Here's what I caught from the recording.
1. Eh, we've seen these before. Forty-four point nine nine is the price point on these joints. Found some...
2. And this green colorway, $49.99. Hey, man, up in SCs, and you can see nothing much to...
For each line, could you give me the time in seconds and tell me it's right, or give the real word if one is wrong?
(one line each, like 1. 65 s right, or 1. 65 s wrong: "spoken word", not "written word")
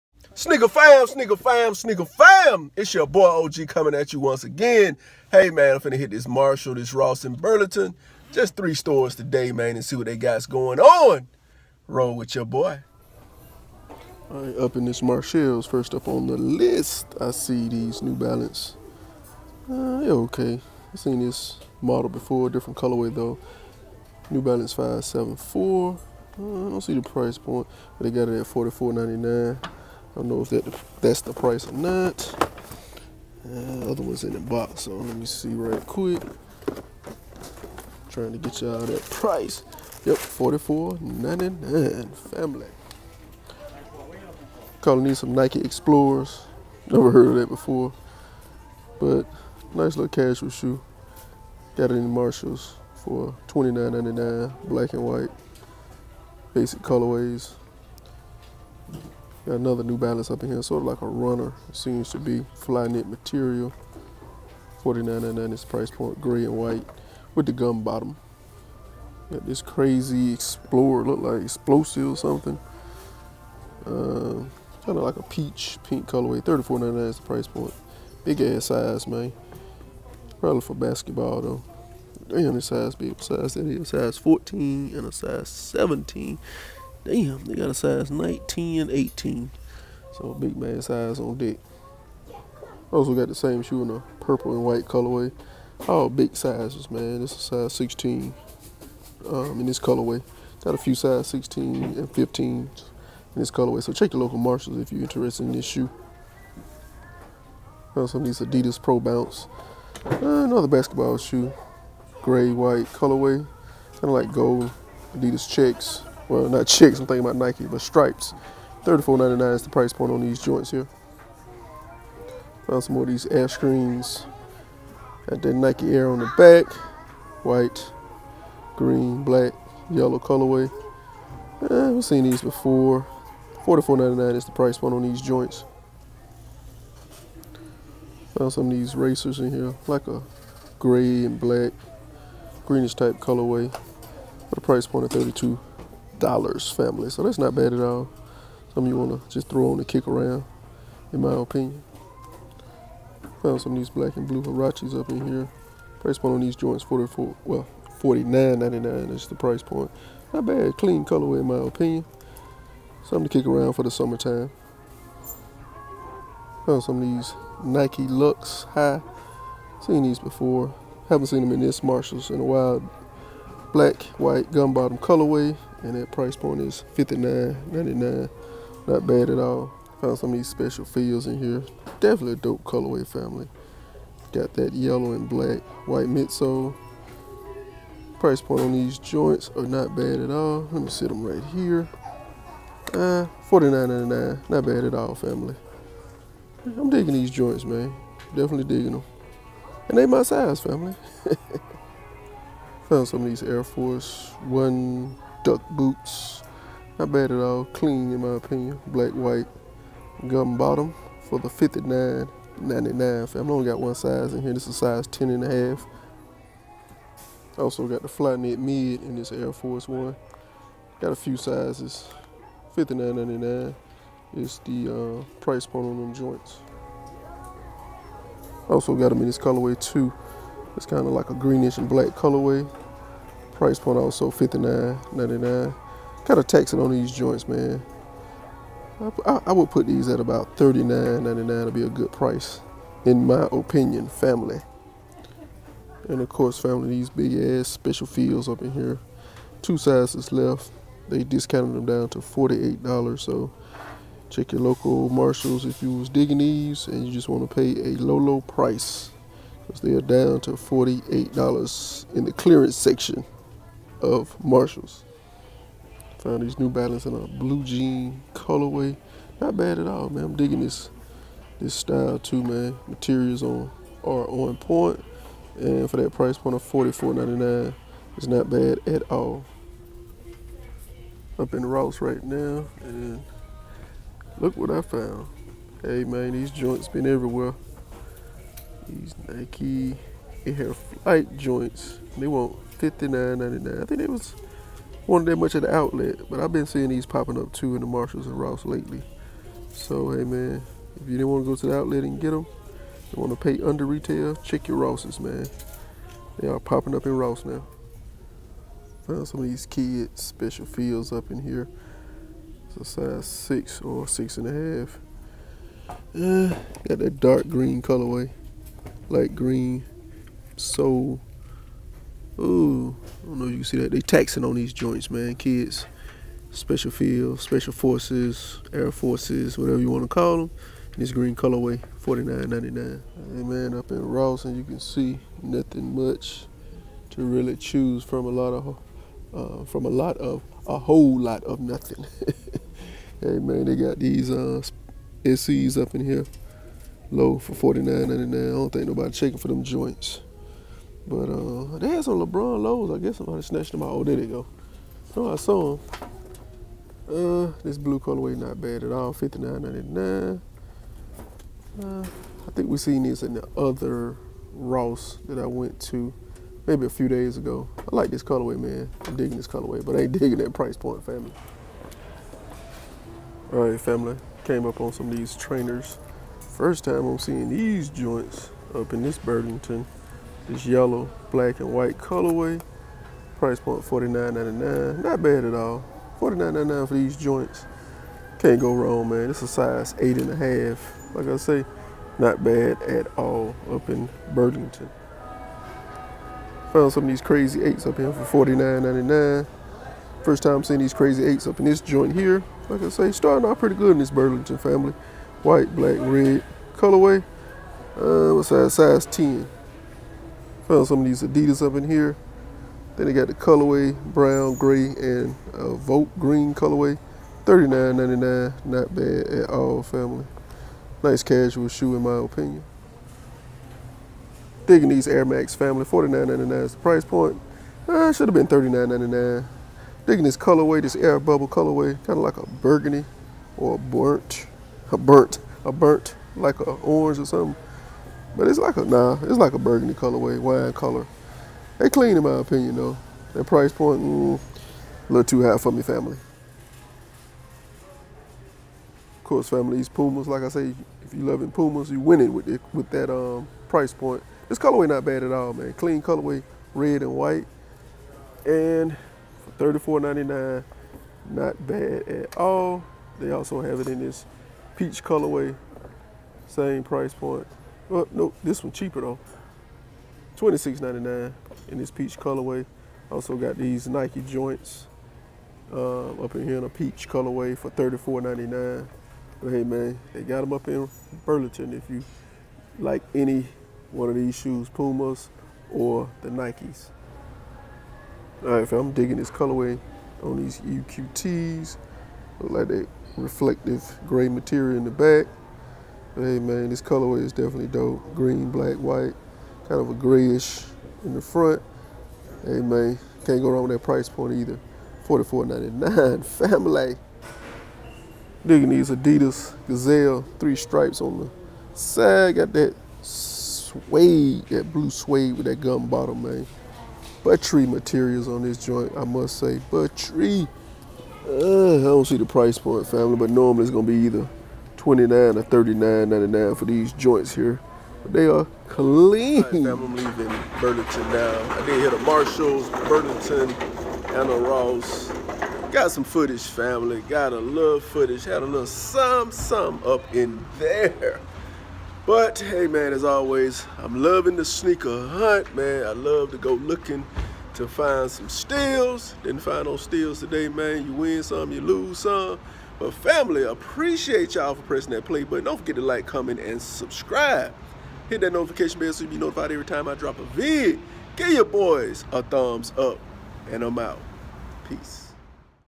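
1. 131 s right
2. 330 s wrong: "Ross", not "SCs".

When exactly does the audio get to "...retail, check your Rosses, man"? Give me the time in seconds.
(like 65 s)
303 s.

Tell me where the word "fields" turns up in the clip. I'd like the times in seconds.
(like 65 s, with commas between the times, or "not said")
180 s, 248 s, 310 s, 326 s.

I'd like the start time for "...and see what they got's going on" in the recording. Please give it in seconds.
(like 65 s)
9 s.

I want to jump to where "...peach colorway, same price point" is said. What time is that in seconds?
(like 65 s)
464 s.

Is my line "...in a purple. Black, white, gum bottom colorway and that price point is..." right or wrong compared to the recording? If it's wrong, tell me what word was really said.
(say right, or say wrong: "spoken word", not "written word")
wrong: "while", not "purple".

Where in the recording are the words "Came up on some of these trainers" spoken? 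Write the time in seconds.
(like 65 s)
374 s.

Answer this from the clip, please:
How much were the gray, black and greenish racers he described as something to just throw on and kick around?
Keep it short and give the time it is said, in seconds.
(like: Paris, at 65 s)
$32, at 145 s.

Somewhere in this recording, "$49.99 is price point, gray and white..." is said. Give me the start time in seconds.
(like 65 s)
64 s.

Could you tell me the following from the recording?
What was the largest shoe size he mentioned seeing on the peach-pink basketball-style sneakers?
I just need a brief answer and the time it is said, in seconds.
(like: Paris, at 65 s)
19, at 87 s.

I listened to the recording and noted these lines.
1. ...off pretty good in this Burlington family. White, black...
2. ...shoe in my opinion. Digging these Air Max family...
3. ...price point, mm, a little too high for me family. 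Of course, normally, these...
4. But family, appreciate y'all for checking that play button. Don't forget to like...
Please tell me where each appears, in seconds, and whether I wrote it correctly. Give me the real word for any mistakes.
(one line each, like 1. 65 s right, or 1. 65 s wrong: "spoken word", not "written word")
1. 403 s right
2. 421 s right
3. 443 s wrong: "family", not "normally"
4. 552 s wrong: "pressing", not "checking".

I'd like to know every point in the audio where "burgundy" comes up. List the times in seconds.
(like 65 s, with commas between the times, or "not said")
432 s, 439 s.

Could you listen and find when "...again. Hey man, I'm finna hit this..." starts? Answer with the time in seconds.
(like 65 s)
4 s.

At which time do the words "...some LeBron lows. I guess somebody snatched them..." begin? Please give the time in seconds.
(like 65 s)
352 s.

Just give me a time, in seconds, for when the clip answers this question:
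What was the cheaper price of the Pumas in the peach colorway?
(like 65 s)
470 s.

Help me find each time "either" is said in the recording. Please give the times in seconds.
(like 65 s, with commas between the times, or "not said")
504 s, 523 s.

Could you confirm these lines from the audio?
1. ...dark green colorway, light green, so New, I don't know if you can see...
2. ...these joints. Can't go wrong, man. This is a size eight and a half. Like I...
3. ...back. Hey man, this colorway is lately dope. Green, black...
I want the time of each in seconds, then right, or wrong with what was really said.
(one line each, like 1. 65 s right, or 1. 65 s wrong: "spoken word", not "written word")
1. 317 s wrong: "Ooh", not "New"
2. 386 s right
3. 494 s wrong: "definitely", not "lately".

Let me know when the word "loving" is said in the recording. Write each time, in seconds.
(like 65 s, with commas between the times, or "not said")
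451 s, 544 s.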